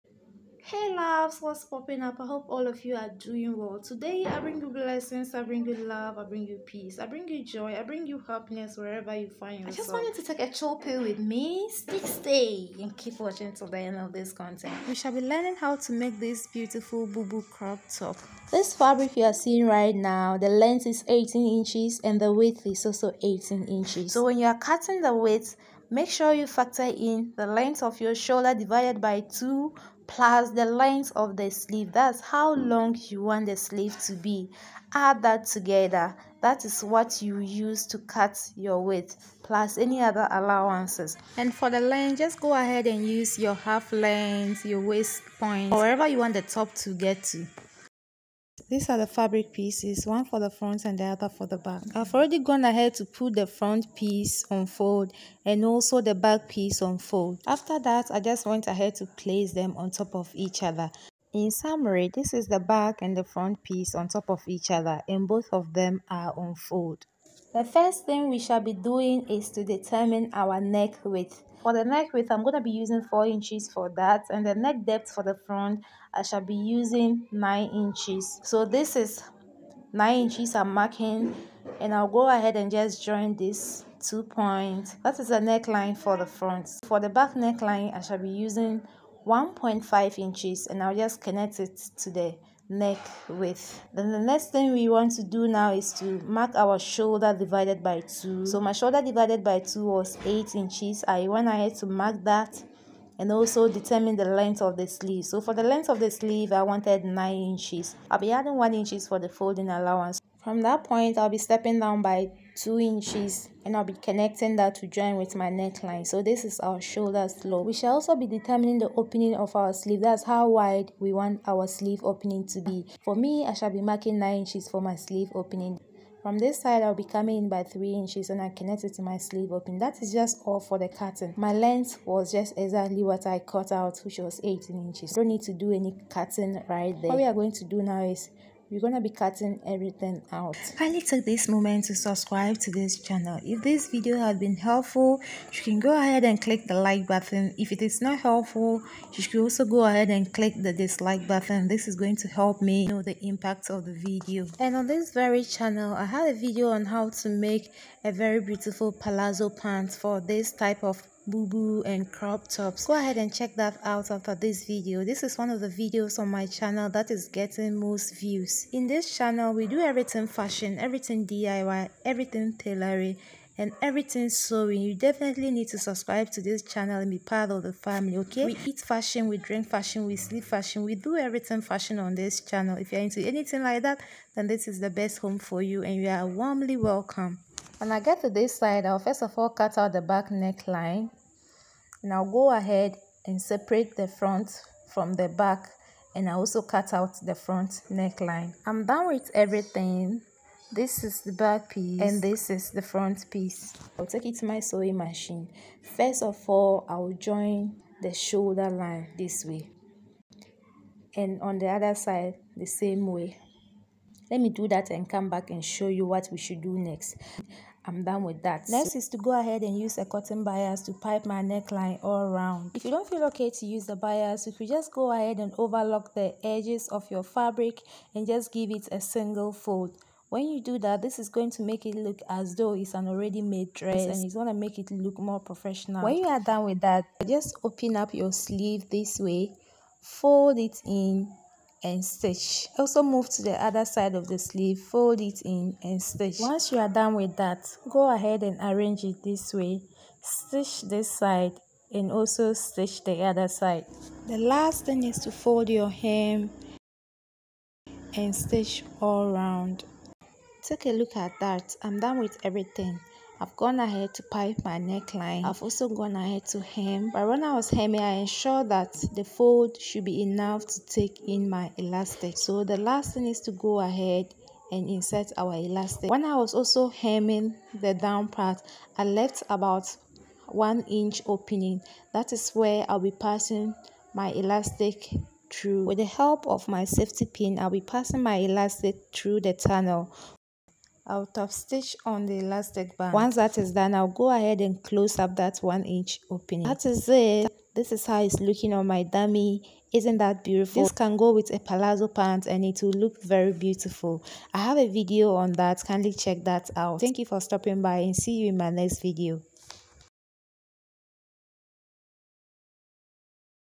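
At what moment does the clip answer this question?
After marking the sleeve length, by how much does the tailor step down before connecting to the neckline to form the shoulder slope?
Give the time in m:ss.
1:52.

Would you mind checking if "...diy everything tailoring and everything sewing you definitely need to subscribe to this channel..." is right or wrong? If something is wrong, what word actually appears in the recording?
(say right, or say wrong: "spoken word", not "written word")
right.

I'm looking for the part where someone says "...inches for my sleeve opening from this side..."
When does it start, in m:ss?
2:04.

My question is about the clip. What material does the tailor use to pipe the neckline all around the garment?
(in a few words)
cotton bias.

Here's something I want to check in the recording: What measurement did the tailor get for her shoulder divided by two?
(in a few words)
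8 inches.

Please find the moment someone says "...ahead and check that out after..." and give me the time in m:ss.
2:42.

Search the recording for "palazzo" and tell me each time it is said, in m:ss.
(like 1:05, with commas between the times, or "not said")
2:38, 5:01.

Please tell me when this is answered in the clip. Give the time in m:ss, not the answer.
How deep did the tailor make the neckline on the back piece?
1:29.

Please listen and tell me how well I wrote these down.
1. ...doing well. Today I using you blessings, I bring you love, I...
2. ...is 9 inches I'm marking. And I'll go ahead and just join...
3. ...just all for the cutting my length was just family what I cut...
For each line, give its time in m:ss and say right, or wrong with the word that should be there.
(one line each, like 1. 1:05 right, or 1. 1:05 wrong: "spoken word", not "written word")
1. 0:03 wrong: "bring", not "using"
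2. 1:18 right
3. 2:10 wrong: "exactly", not "family".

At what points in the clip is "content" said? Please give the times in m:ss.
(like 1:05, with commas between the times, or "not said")
0:14.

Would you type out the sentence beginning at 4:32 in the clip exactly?
So the last thing is to go ahead and insert our elastic.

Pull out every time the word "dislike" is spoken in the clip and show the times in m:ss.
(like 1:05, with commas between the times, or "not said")
2:30.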